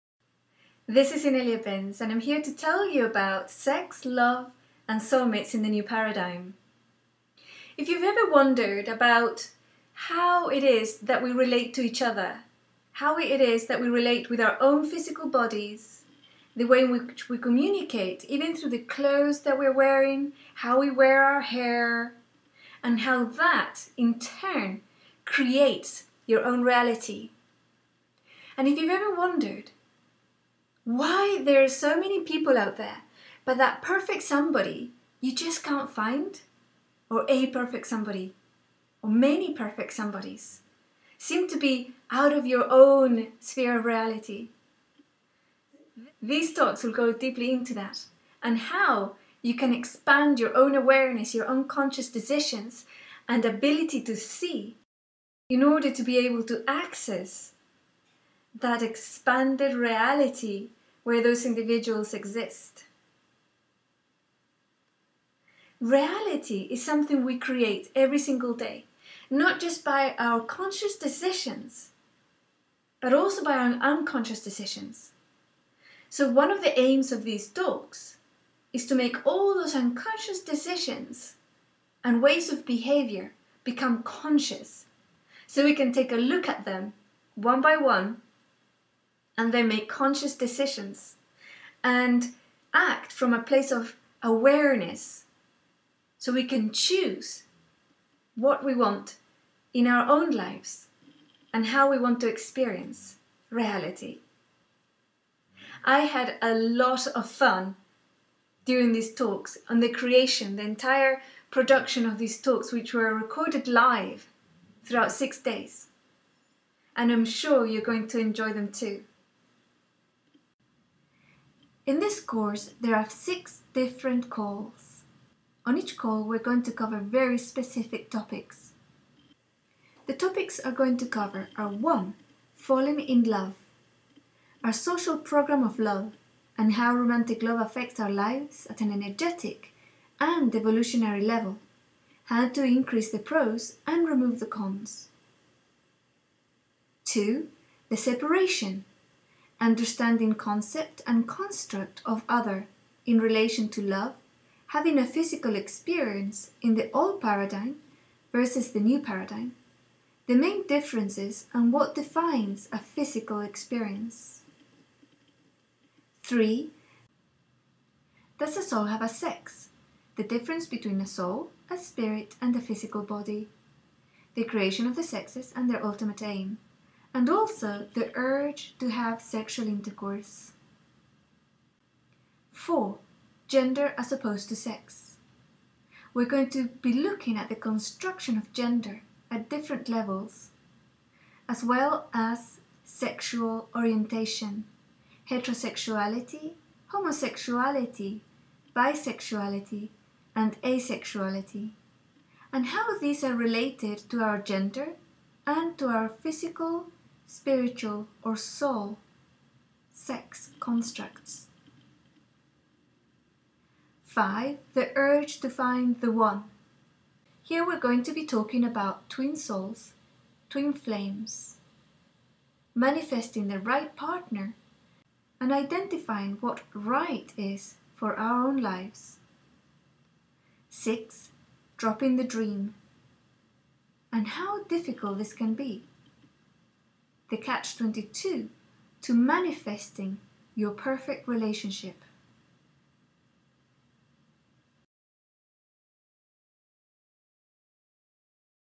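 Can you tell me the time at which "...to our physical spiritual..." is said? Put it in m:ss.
3:25.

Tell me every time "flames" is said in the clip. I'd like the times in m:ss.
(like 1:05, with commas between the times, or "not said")
3:40.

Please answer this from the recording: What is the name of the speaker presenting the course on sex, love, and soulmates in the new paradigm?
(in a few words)
Inelia Benz.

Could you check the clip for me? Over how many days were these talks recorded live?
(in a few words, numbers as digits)
6.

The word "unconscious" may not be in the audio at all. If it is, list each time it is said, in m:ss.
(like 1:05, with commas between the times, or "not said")
0:51, 1:13, 1:19.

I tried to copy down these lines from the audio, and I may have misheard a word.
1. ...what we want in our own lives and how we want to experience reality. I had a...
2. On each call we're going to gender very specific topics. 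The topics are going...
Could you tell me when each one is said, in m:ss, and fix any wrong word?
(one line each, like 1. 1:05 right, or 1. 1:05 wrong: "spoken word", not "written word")
1. 1:38 right
2. 2:05 wrong: "cover", not "gender".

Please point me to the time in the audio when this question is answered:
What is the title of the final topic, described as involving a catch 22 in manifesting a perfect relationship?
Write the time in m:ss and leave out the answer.
3:51.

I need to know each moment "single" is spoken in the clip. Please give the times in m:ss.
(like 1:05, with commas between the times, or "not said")
1:08.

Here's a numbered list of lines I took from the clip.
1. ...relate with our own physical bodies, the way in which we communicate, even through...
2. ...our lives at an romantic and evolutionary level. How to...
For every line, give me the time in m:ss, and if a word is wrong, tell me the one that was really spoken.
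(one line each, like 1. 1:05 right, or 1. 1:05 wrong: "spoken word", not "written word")
1. 0:13 right
2. 2:17 wrong: "energetic", not "romantic".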